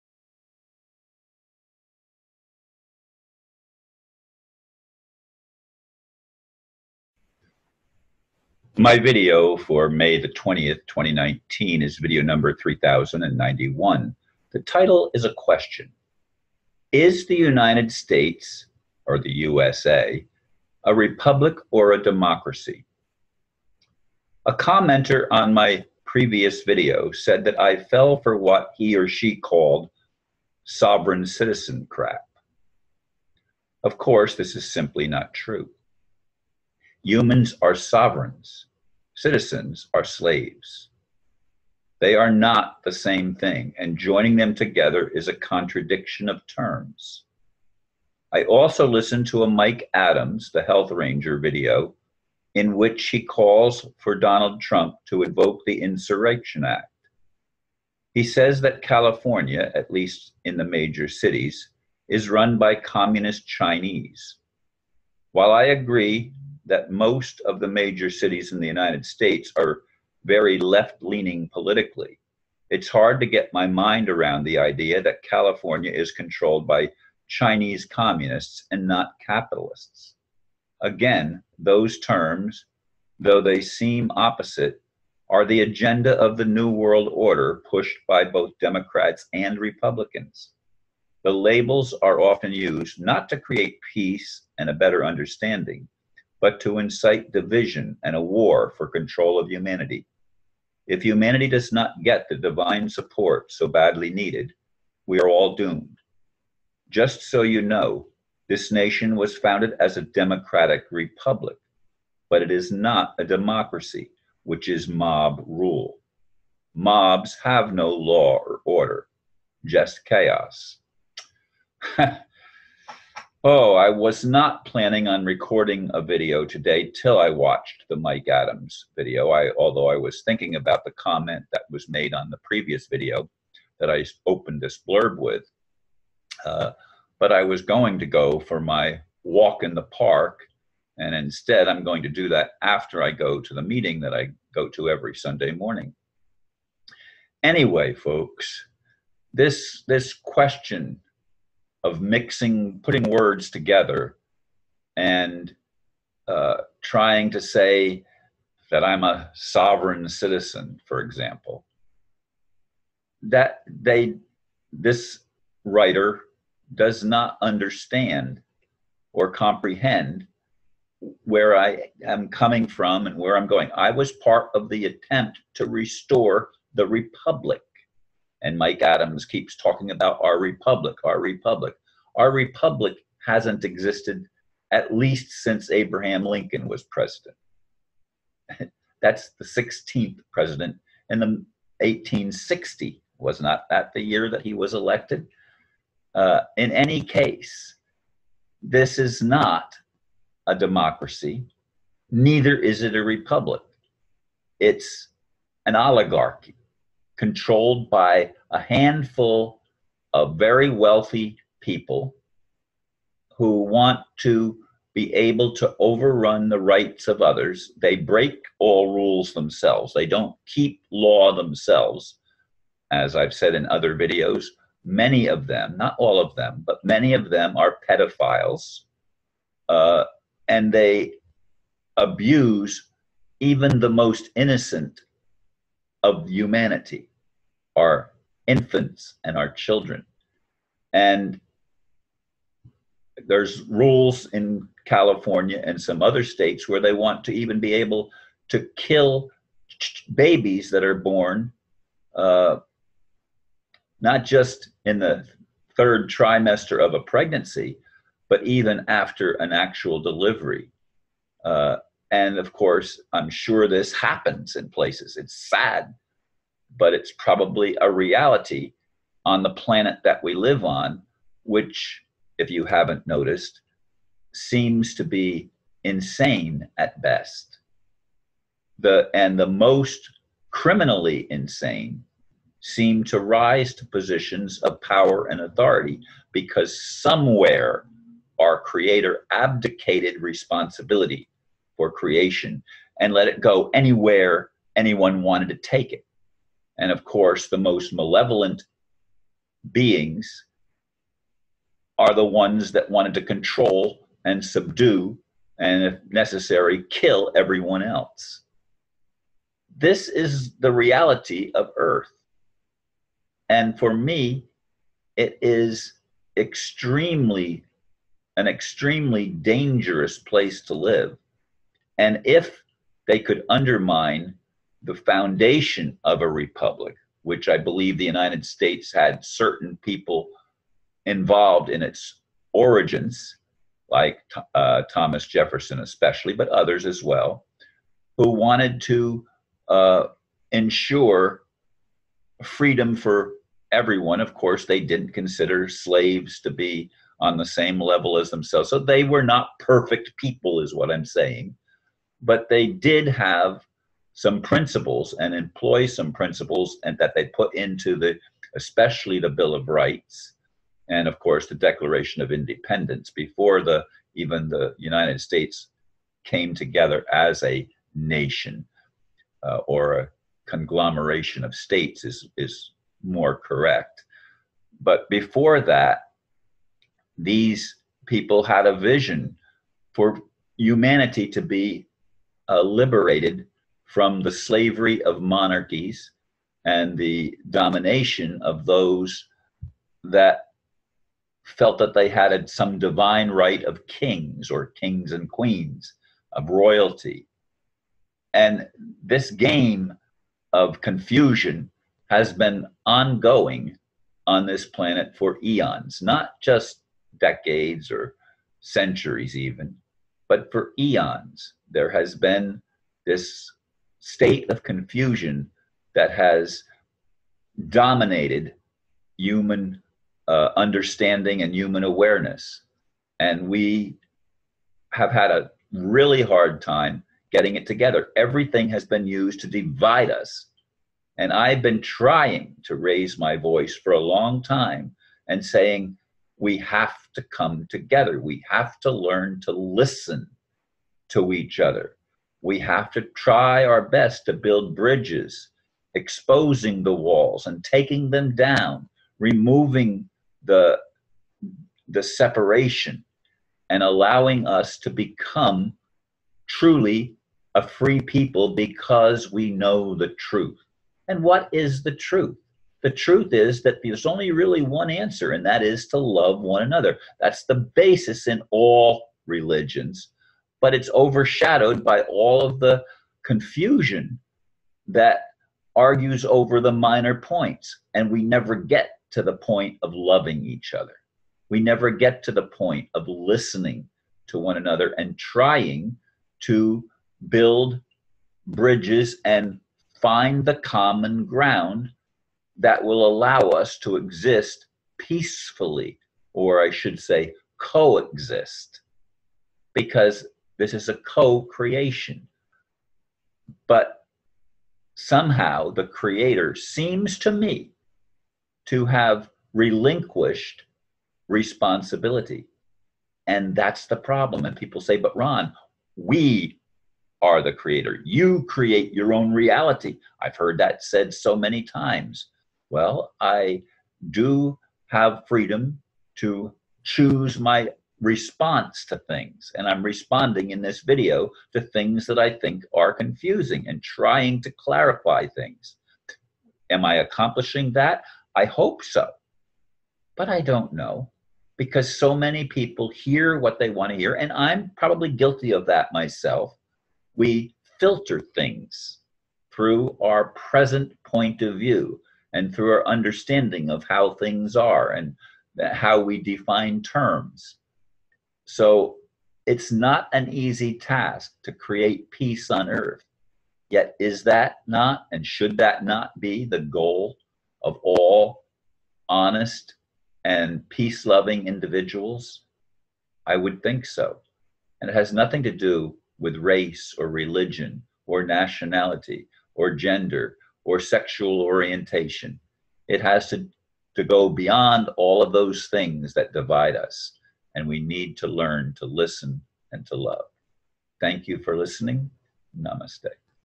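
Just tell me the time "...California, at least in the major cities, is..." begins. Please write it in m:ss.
0:58.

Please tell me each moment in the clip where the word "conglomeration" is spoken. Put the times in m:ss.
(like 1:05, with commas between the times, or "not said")
6:10.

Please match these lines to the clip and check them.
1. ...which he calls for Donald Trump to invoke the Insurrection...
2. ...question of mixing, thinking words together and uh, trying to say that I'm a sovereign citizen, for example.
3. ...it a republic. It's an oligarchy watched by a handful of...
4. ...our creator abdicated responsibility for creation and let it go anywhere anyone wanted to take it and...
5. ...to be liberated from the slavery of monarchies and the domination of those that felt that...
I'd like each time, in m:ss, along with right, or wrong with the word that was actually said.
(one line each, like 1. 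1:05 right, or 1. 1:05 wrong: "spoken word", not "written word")
1. 0:52 right
2. 2:30 wrong: "putting", not "thinking"
3. 3:22 wrong: "controlled", not "watched"
4. 4:48 right
5. 6:21 right.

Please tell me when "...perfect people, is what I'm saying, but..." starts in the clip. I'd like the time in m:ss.
5:49.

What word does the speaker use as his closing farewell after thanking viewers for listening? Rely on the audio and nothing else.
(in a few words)
Namaste.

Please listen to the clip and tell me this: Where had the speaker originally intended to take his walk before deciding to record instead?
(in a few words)
the park.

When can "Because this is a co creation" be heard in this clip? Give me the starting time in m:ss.
8:19.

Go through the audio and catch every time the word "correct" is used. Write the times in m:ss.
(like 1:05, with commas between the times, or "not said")
6:13.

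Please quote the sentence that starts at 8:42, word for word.
Well, I do have freedom to choose my response to things.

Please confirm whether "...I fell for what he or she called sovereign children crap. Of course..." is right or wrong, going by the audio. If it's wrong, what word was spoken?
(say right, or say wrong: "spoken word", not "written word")
wrong: "citizen", not "children".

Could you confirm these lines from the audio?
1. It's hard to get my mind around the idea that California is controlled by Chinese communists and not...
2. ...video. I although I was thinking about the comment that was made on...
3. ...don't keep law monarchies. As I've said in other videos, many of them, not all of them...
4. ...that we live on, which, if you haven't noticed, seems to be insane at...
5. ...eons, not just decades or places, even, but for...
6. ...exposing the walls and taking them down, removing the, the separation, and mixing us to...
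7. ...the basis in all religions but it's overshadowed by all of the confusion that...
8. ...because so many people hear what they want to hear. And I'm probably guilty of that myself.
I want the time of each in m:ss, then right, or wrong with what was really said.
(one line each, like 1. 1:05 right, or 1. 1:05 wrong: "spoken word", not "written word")
1. 1:12 right
2. 2:08 right
3. 3:40 wrong: "themselves", not "monarchies"
4. 4:30 right
5. 6:45 wrong: "centuries", not "places"
6. 7:25 wrong: "allowing", not "mixing"
7. 7:47 right
8. 9:01 right.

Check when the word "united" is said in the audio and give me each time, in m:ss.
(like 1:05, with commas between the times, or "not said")
0:17, 1:08, 5:28, 6:04.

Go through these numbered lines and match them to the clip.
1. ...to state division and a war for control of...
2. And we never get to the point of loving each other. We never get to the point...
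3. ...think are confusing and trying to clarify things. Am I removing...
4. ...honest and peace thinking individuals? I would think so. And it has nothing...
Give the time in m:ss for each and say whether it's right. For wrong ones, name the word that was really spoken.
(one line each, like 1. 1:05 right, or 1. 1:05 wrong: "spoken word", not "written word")
1. 1:36 wrong: "incite", not "state"
2. 7:57 right
3. 8:52 wrong: "accomplishing", not "removing"
4. 9:29 wrong: "loving", not "thinking".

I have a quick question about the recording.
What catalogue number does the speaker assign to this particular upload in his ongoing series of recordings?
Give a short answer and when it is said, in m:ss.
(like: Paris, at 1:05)
3091, at 0:12.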